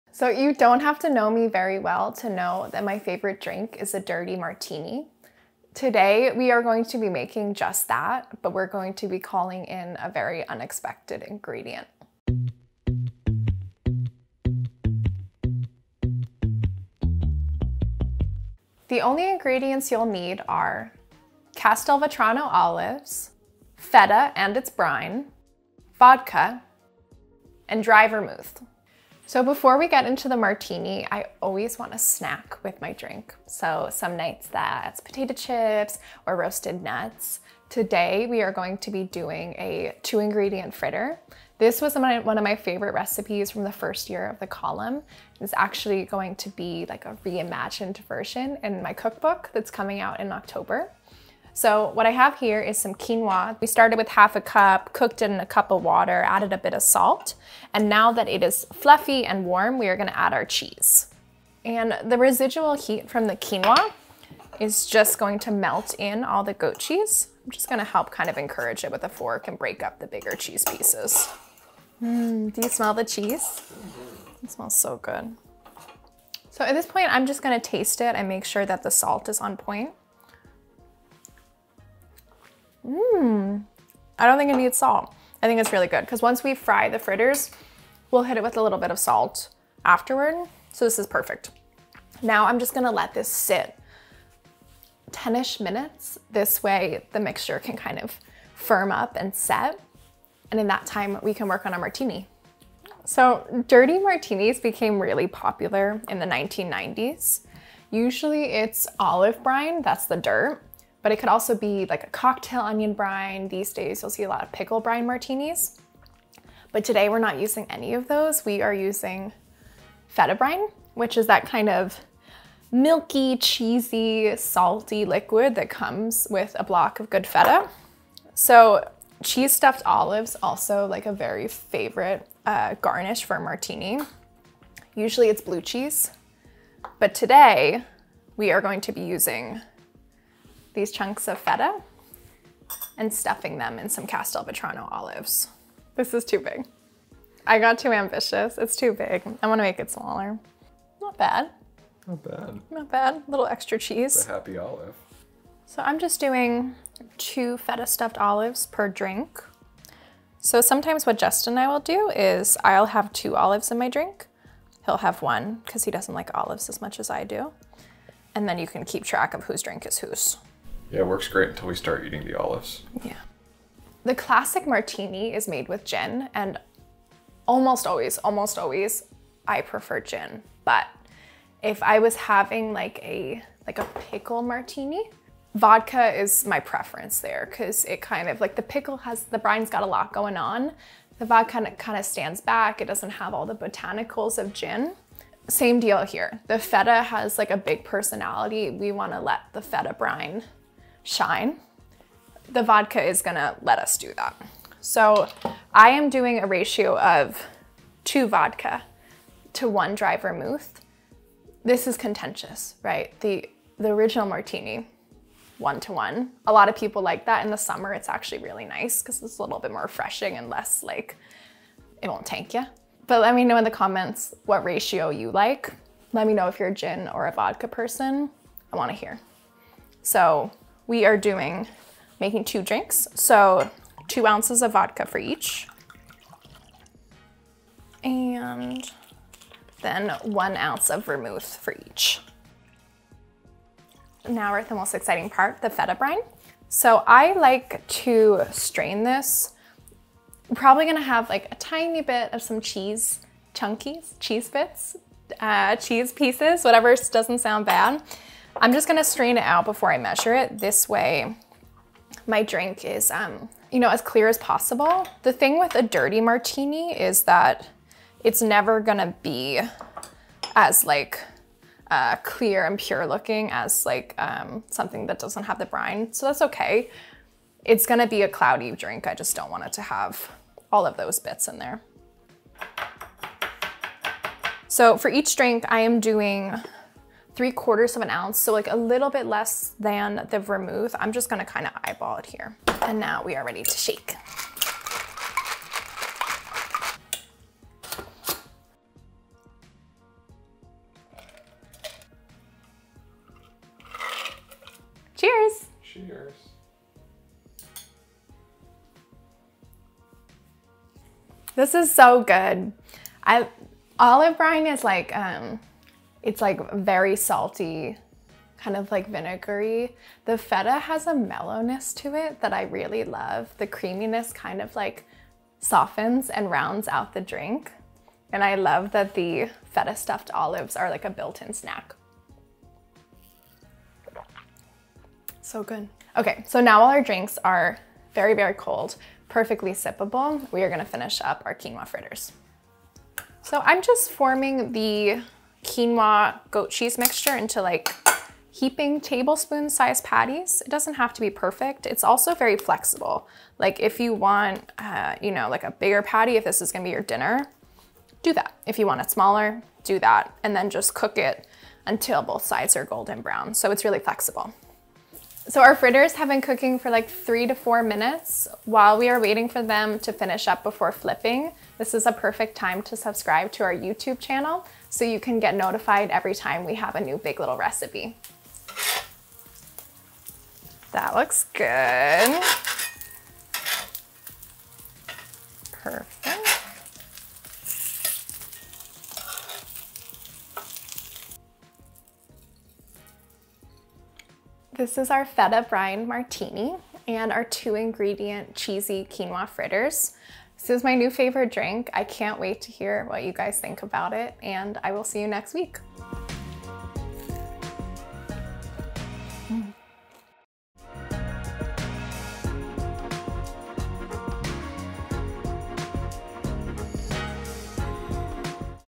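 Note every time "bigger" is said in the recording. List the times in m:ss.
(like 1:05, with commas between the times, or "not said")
1:10, 5:55.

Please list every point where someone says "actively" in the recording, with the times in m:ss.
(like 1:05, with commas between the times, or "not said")
not said.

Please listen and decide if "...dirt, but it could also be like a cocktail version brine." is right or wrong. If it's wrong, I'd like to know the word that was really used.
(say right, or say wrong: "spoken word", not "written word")
wrong: "onion", not "version".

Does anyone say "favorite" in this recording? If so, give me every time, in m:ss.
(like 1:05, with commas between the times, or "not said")
0:02, 0:42, 2:11, 6:41.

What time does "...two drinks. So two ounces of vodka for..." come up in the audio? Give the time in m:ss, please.
3:52.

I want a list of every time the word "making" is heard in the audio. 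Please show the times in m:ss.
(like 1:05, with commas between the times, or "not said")
0:07, 3:52.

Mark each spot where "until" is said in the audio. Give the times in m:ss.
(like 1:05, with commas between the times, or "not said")
2:51, 6:01.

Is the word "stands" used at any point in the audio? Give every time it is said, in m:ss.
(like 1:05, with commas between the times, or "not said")
3:12.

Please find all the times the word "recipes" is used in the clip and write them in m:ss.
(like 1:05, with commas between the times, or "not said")
0:42, 6:17.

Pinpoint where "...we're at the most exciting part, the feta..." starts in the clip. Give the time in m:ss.
4:04.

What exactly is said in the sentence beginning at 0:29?
So before we get into the martini, I always want a snack with my drink.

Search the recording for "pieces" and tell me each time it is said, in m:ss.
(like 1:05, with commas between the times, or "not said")
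1:10, 4:16.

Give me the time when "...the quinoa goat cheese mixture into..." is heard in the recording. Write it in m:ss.
5:44.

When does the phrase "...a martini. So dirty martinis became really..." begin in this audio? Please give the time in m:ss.
1:41.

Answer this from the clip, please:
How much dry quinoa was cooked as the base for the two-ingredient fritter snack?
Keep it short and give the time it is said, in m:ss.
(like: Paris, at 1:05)
half a cup, at 0:54.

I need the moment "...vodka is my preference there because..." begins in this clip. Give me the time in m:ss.
3:05.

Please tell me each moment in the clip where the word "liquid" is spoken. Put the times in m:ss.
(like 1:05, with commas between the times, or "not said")
2:05.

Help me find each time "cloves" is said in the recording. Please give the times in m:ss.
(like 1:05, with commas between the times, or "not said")
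not said.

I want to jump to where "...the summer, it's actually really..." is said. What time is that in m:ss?
3:37.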